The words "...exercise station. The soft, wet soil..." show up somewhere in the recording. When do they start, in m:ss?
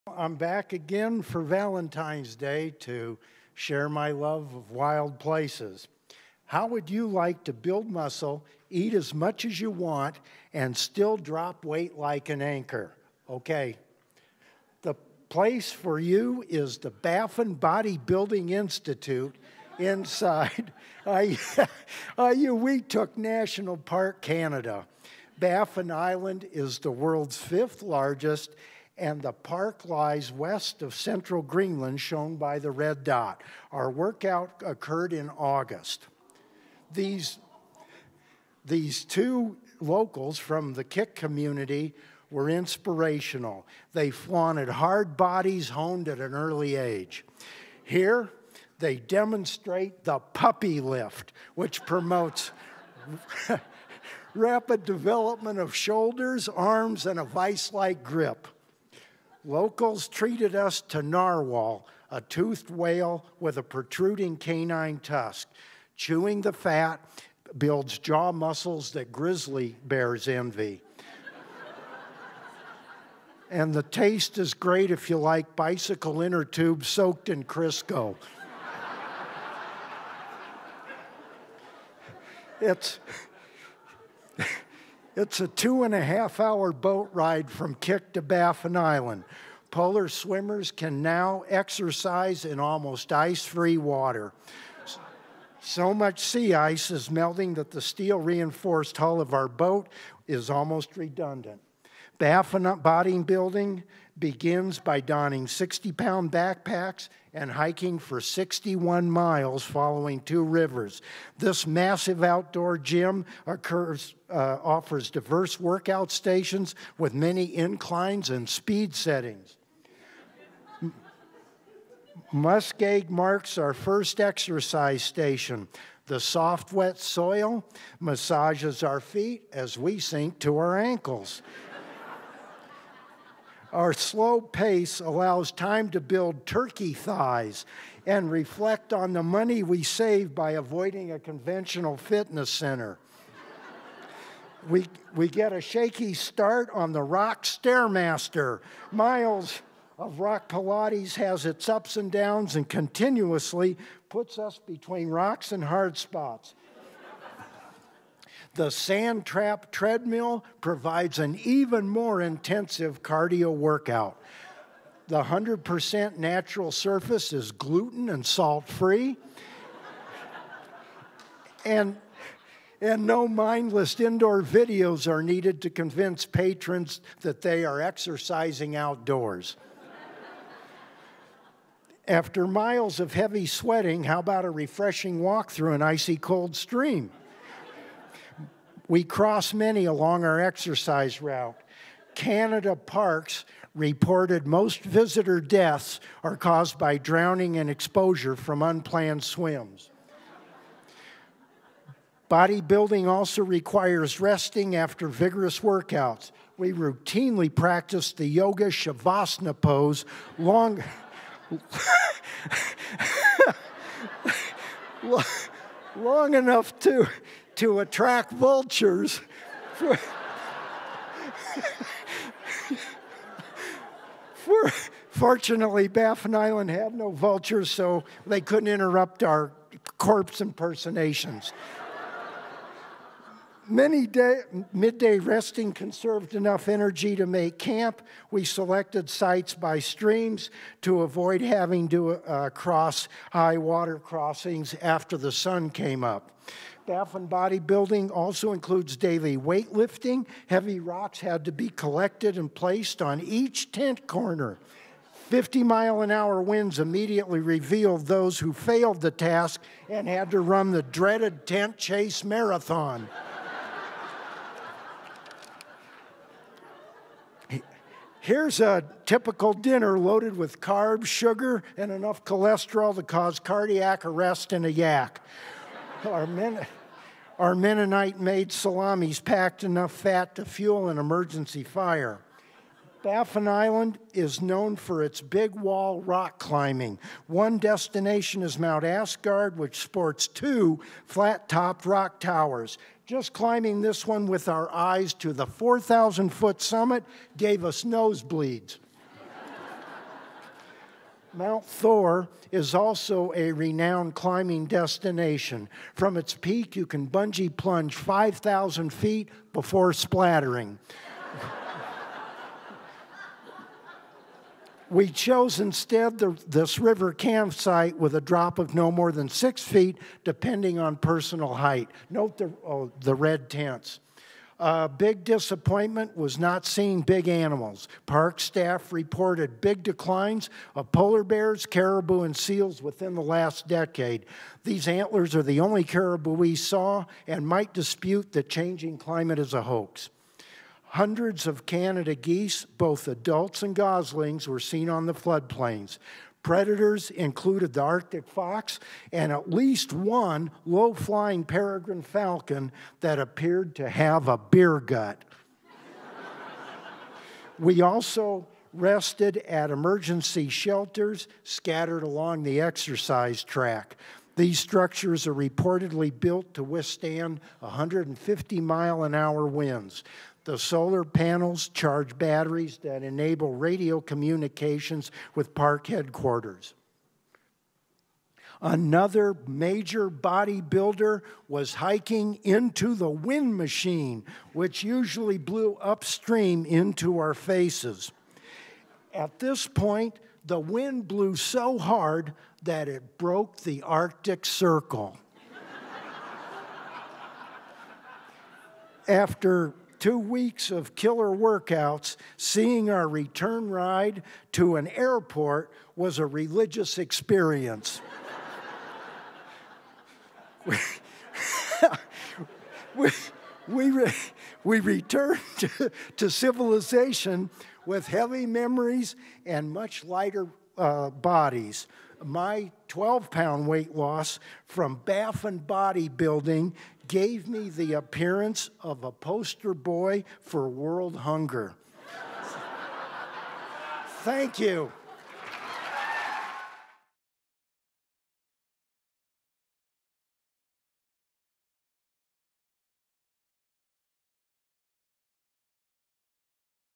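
2:04.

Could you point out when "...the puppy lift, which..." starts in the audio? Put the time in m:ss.
0:50.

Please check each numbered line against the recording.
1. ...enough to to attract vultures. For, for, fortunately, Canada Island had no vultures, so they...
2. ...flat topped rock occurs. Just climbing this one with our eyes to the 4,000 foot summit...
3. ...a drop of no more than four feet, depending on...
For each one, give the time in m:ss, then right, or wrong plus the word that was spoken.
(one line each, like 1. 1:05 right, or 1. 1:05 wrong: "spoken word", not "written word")
1. 3:36 wrong: "Baffin", not "Canada"
2. 4:51 wrong: "towers", not "occurs"
3. 5:18 wrong: "six", not "four".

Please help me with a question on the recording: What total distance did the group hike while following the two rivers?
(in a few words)
61 miles.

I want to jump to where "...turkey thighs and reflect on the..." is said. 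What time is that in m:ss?
2:16.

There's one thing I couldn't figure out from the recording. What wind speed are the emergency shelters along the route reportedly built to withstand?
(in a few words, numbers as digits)
150 mph.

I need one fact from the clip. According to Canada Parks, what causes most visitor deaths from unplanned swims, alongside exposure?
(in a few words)
Drowning.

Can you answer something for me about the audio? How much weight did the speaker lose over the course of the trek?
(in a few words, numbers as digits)
12 pounds.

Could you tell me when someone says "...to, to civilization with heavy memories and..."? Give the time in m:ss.
6:55.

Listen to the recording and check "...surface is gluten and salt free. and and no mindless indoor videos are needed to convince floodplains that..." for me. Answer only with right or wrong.
wrong.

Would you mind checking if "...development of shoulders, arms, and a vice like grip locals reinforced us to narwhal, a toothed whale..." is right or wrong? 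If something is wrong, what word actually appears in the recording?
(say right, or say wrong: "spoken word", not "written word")
wrong: "treated", not "reinforced".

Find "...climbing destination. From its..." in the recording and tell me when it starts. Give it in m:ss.
5:04.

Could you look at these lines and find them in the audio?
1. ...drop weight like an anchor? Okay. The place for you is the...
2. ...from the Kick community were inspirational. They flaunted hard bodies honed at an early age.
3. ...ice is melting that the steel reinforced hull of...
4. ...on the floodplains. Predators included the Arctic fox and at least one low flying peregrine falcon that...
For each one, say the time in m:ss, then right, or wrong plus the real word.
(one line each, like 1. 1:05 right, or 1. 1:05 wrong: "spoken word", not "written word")
1. 0:11 right
2. 0:40 right
3. 1:36 right
4. 5:44 right.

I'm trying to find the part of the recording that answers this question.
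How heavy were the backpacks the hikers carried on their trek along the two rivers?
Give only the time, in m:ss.
1:45.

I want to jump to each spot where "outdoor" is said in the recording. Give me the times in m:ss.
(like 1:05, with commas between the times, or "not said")
1:52, 2:58.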